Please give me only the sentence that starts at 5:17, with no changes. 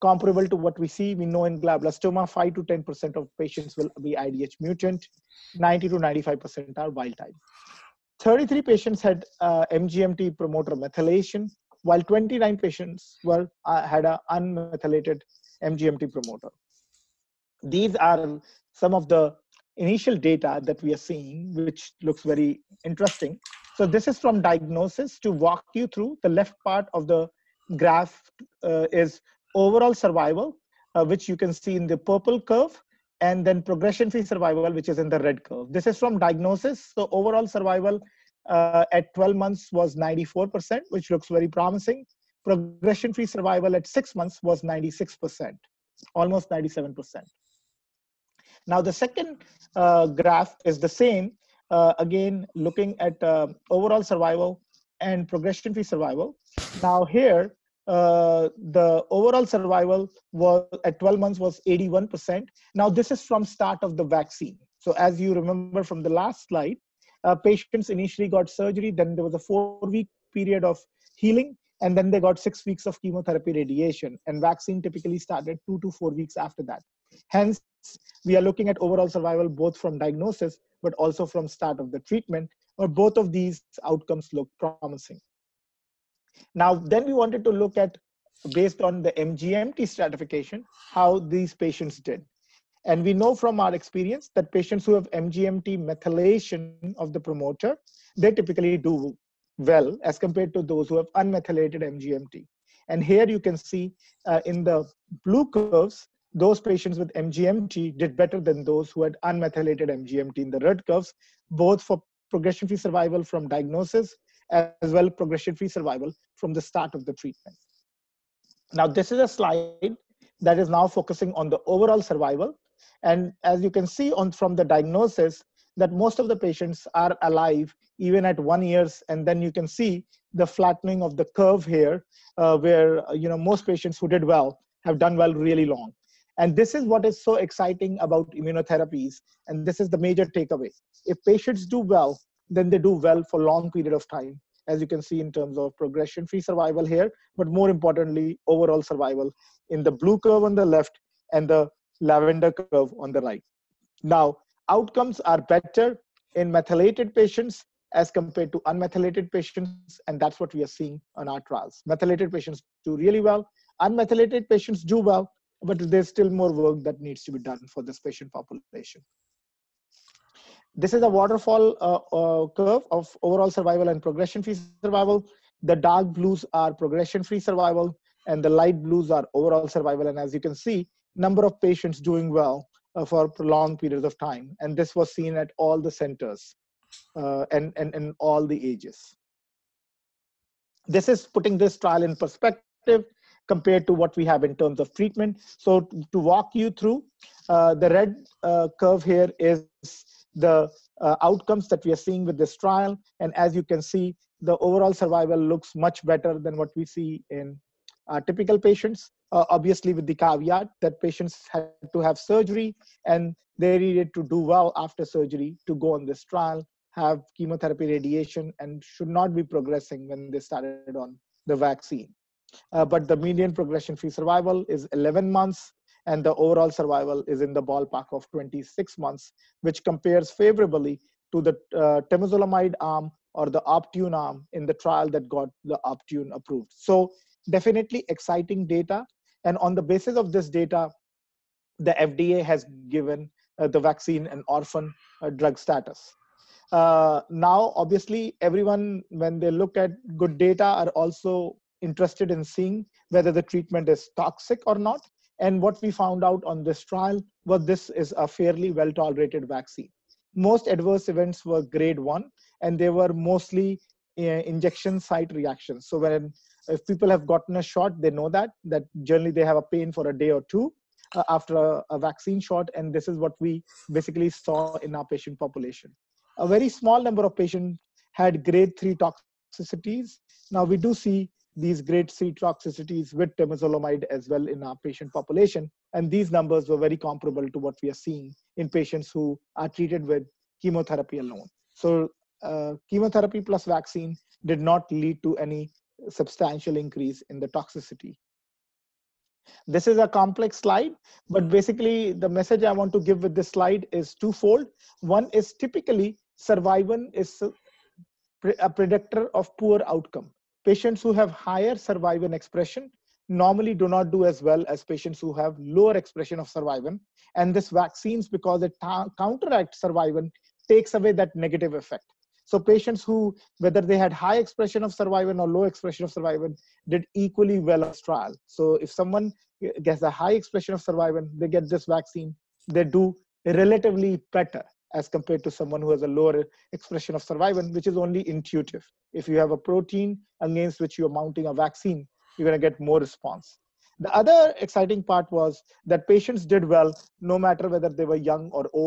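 And this vaccines, because it counteracts survivin, takes away that negative effect.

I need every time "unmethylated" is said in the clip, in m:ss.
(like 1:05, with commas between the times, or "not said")
0:14, 1:41, 1:49, 2:38, 2:43.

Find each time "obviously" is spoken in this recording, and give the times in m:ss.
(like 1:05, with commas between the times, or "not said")
3:29, 4:07.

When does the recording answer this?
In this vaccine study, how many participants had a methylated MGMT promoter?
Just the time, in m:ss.
0:08.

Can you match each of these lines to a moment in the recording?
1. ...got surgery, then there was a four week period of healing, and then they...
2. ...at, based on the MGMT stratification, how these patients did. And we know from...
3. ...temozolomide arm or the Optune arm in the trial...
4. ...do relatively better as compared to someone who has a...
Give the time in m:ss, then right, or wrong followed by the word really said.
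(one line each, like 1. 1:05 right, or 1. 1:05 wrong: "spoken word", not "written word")
1. 1:08 right
2. 1:27 right
3. 3:52 right
4. 5:32 right.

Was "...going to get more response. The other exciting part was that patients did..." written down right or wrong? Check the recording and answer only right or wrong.
right.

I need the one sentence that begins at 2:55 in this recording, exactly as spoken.
The dark blues are progression-free survival, and the light blues are overall survival.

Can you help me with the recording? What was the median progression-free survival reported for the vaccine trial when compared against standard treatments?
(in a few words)
11 months.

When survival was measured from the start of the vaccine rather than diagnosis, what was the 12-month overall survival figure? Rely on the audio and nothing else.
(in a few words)
81%.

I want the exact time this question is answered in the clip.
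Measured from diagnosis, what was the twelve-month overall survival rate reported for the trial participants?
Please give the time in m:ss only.
0:39.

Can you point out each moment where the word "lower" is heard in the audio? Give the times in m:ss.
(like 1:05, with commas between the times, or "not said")
5:15, 5:36.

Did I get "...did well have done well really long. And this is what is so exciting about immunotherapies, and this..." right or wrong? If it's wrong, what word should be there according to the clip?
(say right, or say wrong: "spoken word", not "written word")
right.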